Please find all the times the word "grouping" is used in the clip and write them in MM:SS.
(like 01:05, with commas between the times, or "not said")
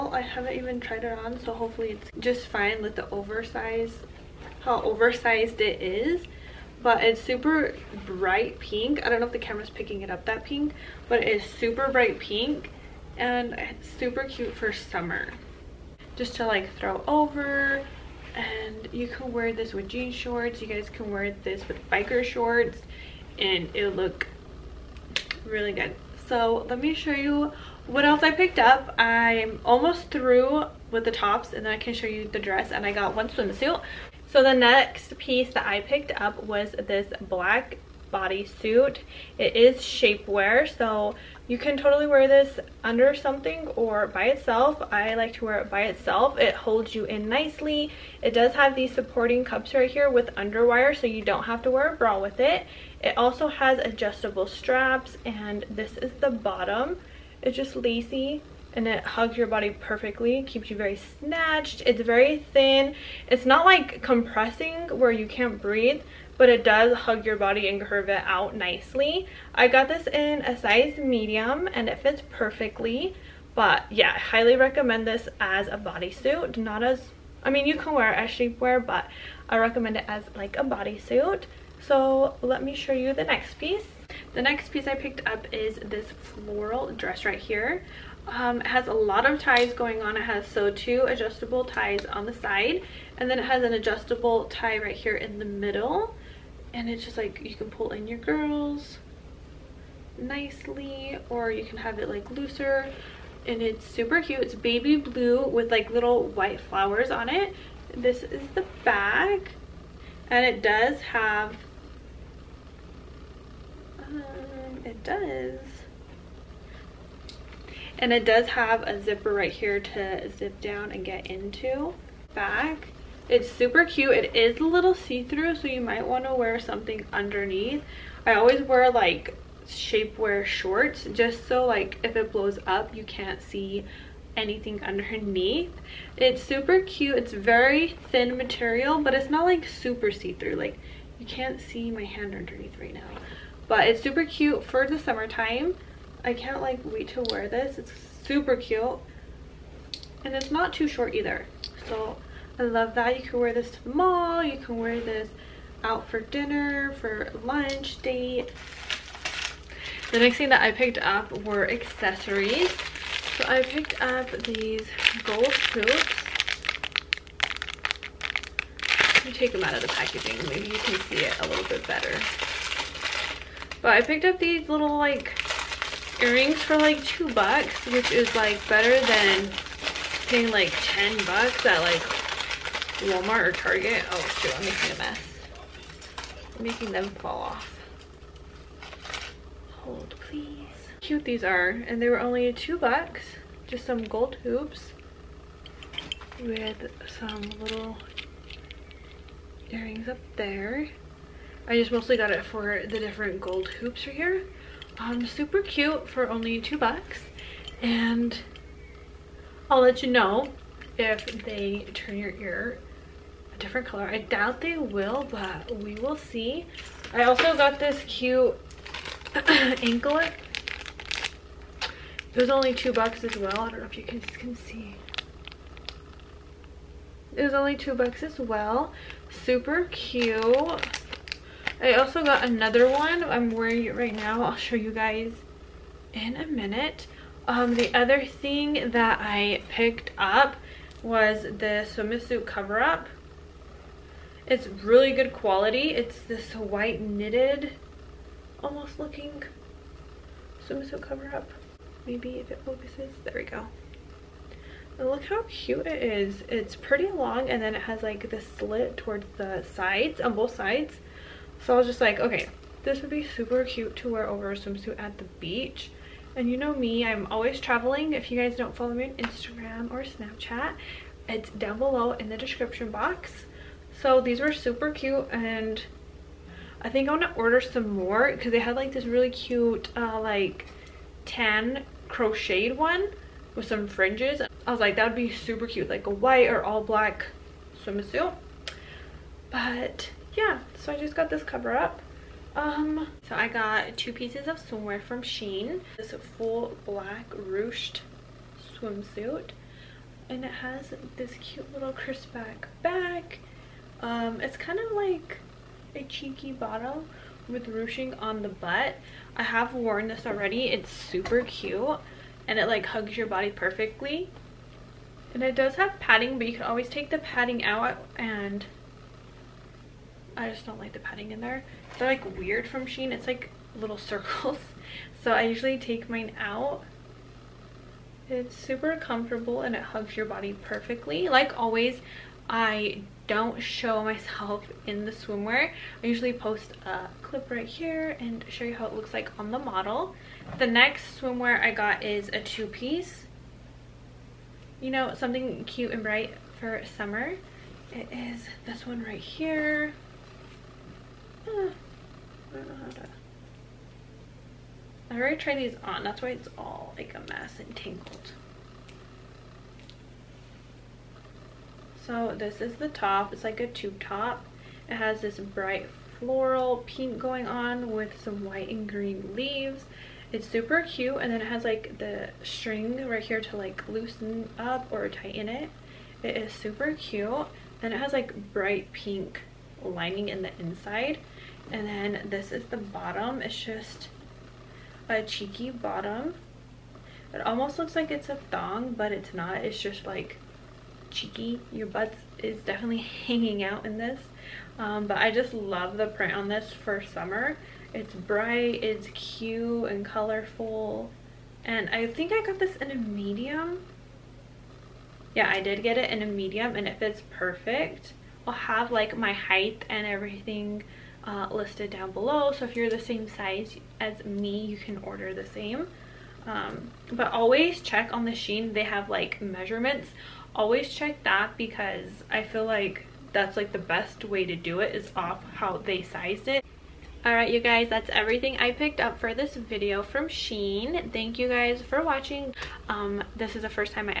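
not said.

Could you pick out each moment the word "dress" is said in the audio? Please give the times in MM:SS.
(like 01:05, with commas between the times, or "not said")
00:32, 01:26.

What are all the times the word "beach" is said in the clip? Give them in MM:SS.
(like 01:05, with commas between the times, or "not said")
04:25.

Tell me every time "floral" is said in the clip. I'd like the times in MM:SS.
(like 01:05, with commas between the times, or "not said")
01:26, 06:06.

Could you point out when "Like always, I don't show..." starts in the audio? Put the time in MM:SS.
05:31.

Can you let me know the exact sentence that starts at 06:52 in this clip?
So if you're the same size as me, you can order the same.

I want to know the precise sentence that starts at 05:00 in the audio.
And it has this cute little crisp back back.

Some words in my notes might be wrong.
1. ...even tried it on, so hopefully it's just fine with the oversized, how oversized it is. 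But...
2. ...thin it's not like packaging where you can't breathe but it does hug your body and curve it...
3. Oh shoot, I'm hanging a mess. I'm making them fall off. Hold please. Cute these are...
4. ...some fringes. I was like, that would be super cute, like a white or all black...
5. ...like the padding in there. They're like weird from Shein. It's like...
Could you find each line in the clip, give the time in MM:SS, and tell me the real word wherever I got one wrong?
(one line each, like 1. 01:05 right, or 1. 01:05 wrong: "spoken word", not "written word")
1. 00:00 right
2. 01:02 wrong: "compressing", not "packaging"
3. 03:04 wrong: "making", not "hanging"
4. 04:43 right
5. 05:20 right.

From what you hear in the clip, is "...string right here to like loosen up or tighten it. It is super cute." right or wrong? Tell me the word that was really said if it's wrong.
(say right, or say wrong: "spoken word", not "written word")
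right.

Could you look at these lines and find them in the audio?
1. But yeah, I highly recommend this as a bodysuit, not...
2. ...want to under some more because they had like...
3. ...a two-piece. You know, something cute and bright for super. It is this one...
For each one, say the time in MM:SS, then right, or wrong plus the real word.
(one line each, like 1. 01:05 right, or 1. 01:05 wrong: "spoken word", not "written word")
1. 01:13 right
2. 04:37 wrong: "order", not "under"
3. 05:42 wrong: "summer", not "super".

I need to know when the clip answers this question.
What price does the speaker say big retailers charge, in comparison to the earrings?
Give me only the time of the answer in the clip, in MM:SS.
03:00.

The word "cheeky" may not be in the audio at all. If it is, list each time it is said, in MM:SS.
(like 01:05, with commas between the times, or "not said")
05:06, 06:25, 06:31.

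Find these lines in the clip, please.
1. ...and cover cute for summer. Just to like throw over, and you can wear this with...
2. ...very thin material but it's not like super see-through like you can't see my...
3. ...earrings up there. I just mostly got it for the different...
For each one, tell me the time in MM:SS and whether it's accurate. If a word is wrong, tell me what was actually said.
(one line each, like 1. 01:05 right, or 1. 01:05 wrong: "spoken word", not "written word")
1. 00:13 wrong: "super", not "cover"
2. 02:17 right
3. 03:19 right.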